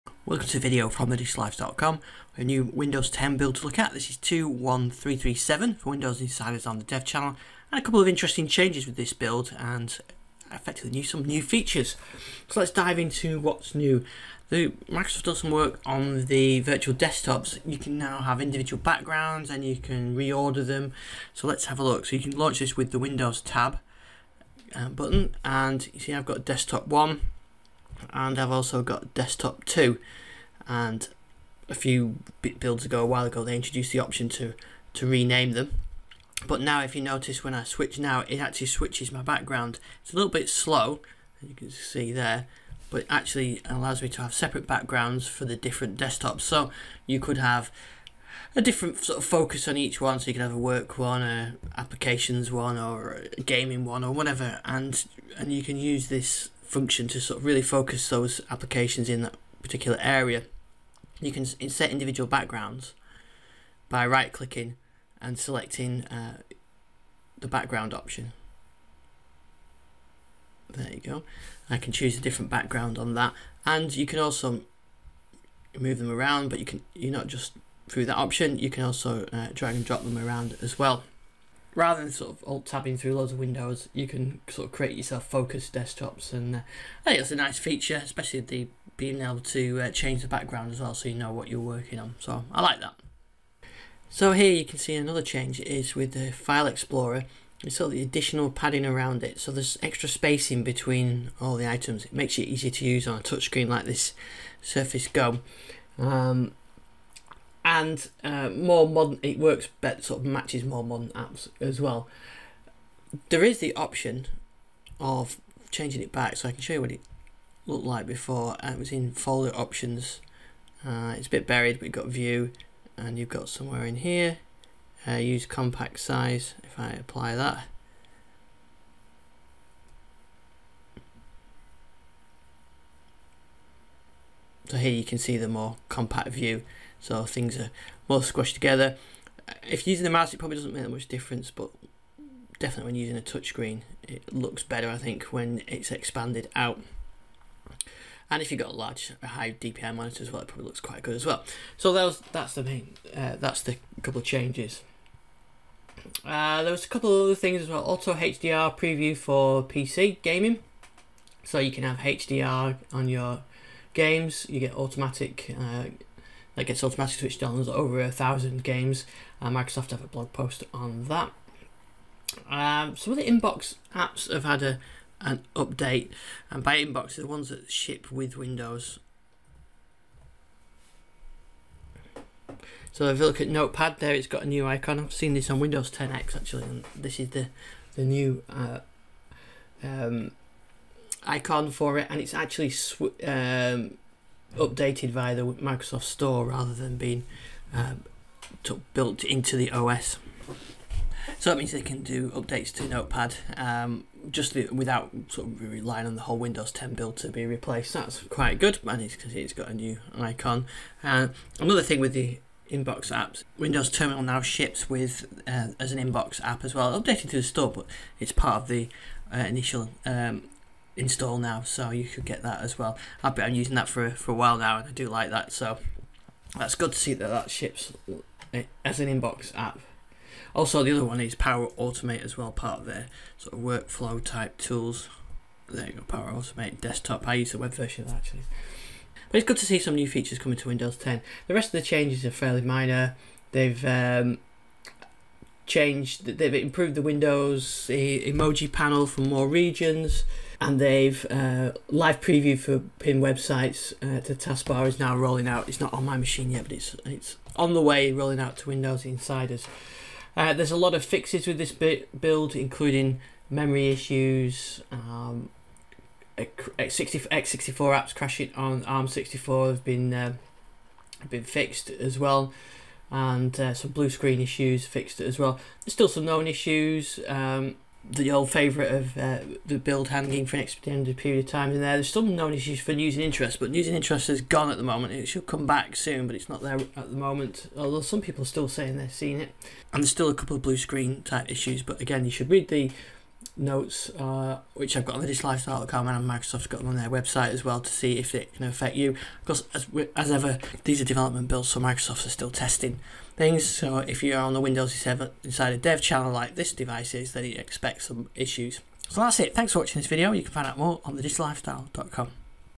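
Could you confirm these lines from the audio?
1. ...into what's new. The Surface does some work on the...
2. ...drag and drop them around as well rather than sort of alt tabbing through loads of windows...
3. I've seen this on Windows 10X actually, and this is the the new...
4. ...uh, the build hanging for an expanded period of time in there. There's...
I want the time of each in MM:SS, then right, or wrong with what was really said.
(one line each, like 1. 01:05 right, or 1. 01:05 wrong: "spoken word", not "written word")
1. 00:12 wrong: "Microsoft", not "Surface"
2. 01:19 right
3. 03:04 right
4. 04:39 wrong: "extended", not "expanded".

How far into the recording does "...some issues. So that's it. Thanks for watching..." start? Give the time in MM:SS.
05:08.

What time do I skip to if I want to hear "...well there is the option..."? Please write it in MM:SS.
01:51.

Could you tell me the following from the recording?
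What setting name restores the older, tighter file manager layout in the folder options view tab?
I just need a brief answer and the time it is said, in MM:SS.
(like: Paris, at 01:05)
Use compact size, at 02:05.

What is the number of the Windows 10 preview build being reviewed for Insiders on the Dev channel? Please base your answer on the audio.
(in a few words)
21337.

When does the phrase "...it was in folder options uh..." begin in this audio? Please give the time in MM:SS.
01:58.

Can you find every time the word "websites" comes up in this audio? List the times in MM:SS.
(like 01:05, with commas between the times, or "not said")
04:13, 04:57.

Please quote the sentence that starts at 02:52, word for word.
Um, some of the inbox apps have had a an update, and by inbox, the ones that ship with Windows.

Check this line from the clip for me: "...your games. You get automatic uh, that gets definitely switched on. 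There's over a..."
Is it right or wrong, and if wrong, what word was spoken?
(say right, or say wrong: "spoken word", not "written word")
wrong: "automatically", not "definitely".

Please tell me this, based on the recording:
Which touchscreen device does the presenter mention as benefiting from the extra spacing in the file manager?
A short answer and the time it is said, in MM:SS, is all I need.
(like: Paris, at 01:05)
Surface Go, at 01:44.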